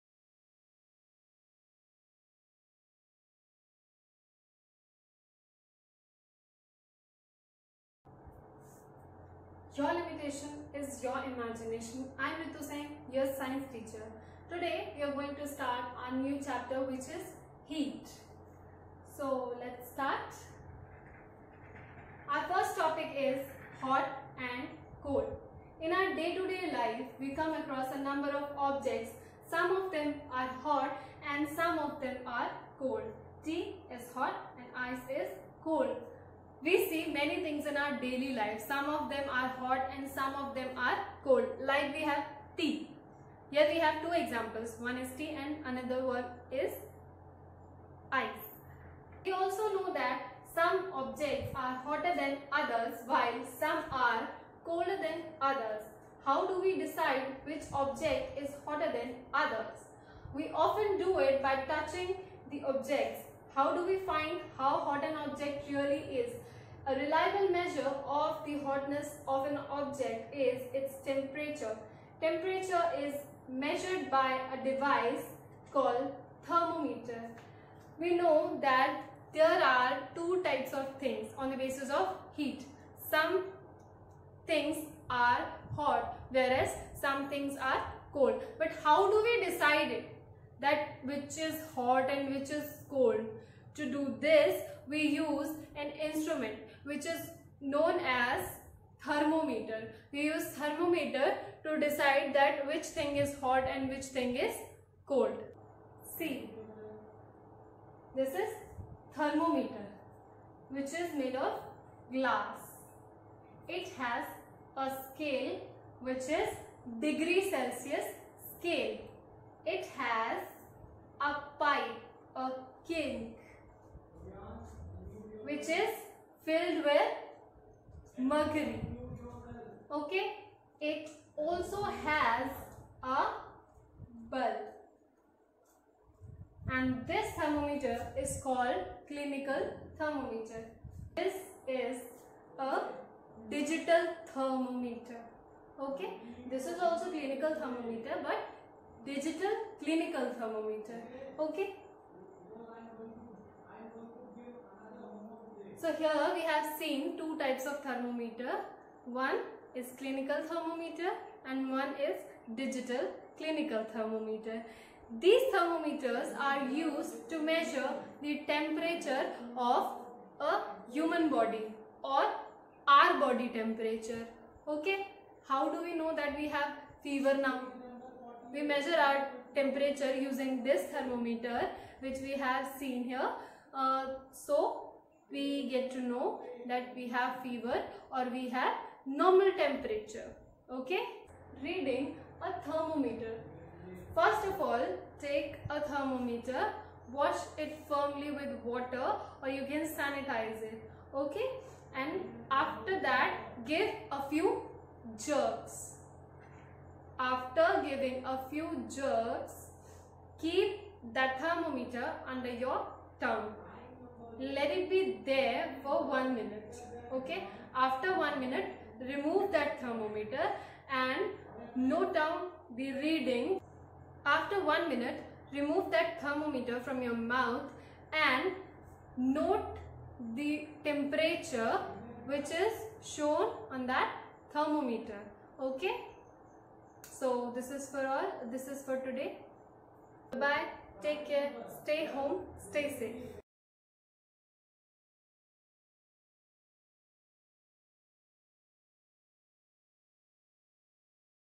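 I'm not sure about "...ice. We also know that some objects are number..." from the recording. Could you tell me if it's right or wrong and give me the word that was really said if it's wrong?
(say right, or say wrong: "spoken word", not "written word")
wrong: "hotter", not "number".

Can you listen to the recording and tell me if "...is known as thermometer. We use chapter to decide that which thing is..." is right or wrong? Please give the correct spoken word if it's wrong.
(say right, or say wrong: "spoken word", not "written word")
wrong: "thermometer", not "chapter".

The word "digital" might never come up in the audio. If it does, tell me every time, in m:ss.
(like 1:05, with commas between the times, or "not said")
2:23, 2:29, 2:42.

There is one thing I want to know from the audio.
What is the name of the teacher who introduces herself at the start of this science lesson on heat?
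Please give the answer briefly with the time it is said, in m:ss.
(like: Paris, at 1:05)
Ritu Singh, at 0:12.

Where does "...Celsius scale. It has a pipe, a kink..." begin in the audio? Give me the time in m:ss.
1:57.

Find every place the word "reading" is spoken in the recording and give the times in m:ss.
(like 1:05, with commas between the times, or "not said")
3:11, 3:42.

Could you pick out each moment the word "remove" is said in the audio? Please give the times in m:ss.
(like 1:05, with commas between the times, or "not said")
3:39, 3:45.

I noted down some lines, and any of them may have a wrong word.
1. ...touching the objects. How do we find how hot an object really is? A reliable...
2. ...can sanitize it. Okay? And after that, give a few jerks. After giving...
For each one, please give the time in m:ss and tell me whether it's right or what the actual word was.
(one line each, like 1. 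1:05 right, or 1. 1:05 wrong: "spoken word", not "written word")
1. 1:01 right
2. 3:19 right.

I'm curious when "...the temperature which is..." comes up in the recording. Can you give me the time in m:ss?
3:50.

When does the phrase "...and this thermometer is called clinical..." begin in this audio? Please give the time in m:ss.
2:16.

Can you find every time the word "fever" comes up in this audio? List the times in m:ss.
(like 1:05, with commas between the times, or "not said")
2:57, 3:07.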